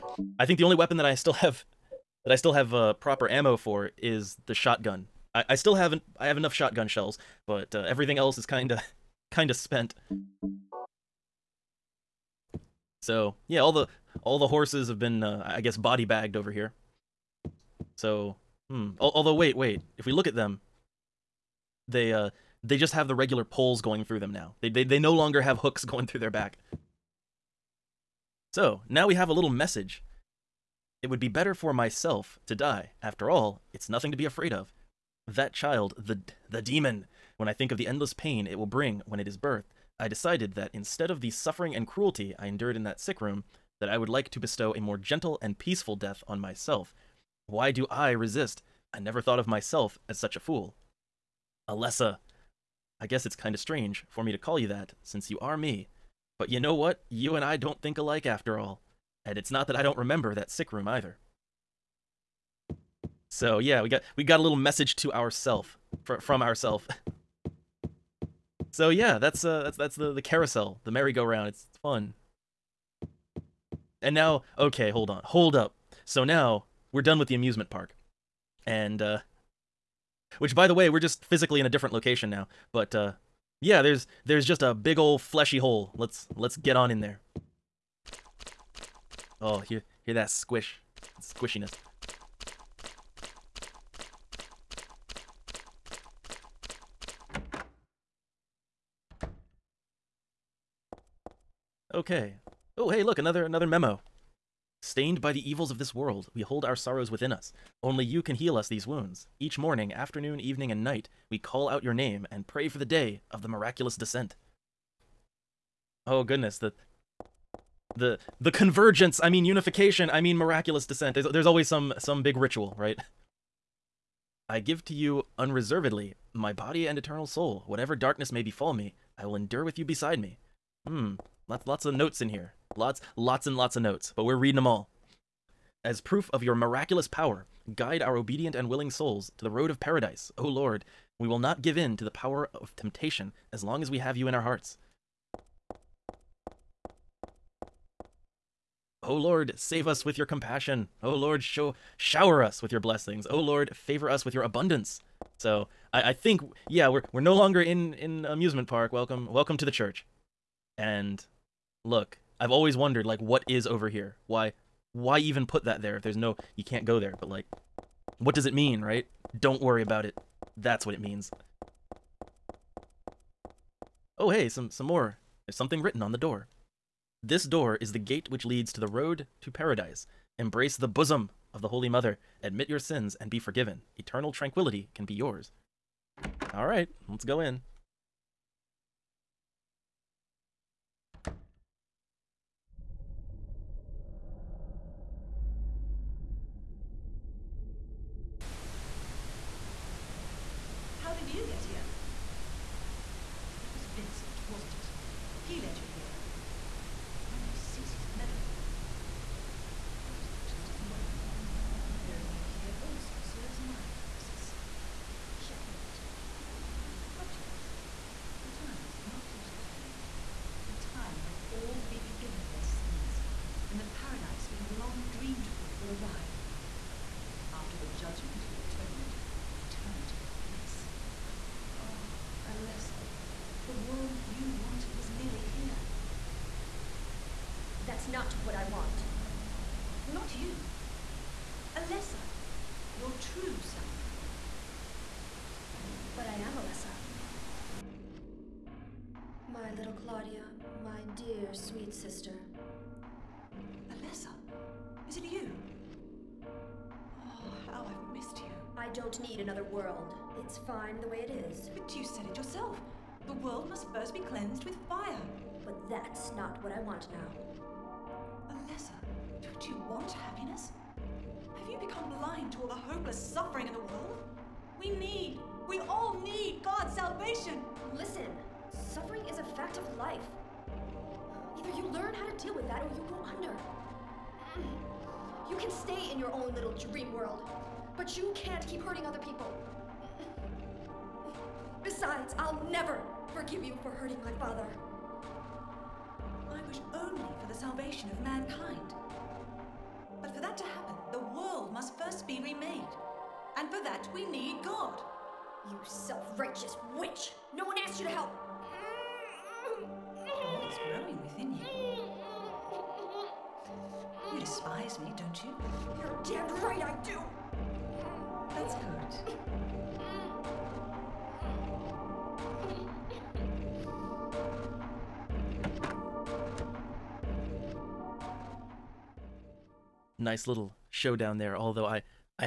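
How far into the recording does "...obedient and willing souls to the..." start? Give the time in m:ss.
2:18.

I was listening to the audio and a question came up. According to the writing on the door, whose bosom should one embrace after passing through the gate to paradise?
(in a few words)
The Holy Mother.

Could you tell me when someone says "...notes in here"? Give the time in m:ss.
2:11.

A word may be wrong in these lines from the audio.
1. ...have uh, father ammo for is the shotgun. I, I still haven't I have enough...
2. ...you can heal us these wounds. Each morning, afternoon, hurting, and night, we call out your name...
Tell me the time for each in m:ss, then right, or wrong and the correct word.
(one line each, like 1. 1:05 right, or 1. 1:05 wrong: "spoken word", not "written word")
1. 0:02 wrong: "proper", not "father"
2. 1:48 wrong: "evening", not "hurting".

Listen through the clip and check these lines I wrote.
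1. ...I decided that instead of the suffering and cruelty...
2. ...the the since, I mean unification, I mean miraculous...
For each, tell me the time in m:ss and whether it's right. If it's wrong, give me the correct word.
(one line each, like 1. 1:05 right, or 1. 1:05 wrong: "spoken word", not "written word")
1. 0:39 right
2. 1:57 wrong: "convergence", not "since".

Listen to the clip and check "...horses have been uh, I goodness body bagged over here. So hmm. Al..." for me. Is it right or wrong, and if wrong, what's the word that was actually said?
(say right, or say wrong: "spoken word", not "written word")
wrong: "guess", not "goodness".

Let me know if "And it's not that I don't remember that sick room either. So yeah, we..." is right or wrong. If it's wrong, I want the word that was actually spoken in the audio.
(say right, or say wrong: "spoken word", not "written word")
right.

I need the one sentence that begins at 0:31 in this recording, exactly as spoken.
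It would be better for myself to die.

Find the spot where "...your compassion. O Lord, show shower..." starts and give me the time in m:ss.
2:30.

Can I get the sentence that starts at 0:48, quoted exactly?
I never thought of myself as such a fool.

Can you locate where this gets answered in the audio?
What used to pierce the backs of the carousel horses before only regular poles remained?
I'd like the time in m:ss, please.
0:25.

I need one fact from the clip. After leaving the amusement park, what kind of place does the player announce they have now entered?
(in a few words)
The church.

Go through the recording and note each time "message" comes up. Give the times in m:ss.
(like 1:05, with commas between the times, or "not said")
0:29, 1:04.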